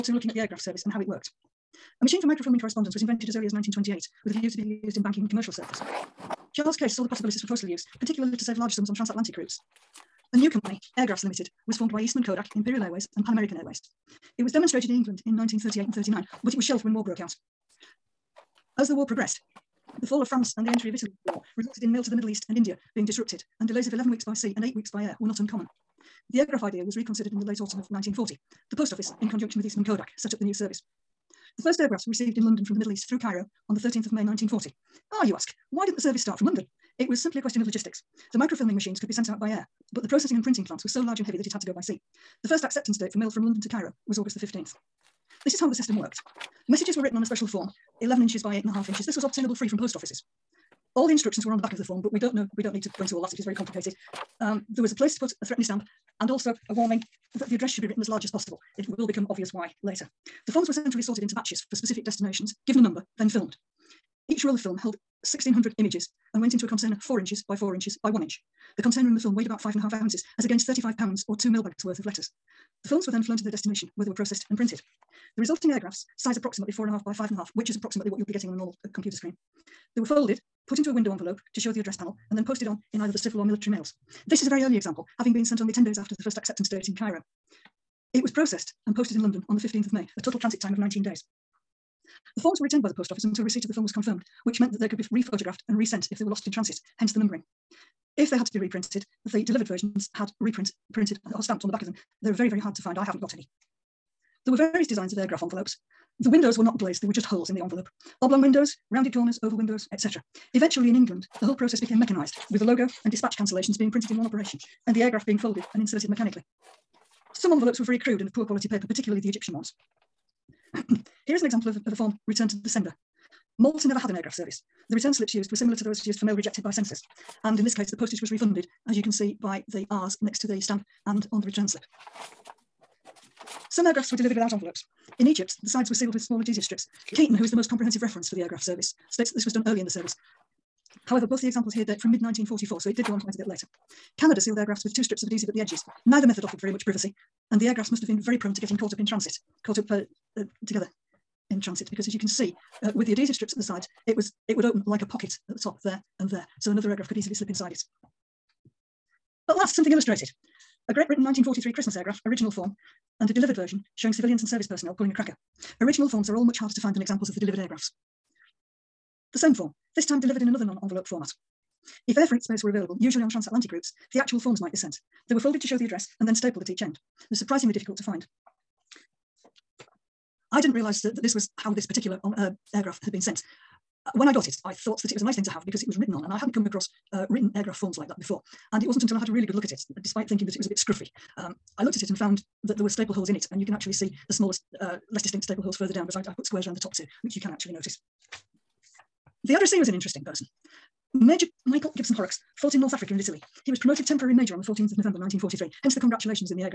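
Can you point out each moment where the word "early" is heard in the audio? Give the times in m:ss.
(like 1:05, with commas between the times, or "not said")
0:03, 1:24, 2:19.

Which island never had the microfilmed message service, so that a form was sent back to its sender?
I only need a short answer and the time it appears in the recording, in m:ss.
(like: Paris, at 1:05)
Malta, at 2:03.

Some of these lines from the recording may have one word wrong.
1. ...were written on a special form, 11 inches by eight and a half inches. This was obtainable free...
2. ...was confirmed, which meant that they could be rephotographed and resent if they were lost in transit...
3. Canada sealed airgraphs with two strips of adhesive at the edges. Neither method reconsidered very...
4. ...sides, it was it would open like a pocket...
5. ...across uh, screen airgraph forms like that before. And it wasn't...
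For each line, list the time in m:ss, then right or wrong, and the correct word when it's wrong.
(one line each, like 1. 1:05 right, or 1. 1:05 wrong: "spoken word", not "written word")
1. 0:46 right
2. 1:33 right
3. 2:24 wrong: "offered", not "reconsidered"
4. 2:33 right
5. 3:06 wrong: "written", not "screen".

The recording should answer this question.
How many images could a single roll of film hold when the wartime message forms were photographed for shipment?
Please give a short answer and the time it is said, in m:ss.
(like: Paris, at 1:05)
1,600, at 1:05.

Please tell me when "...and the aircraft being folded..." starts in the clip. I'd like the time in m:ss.
1:54.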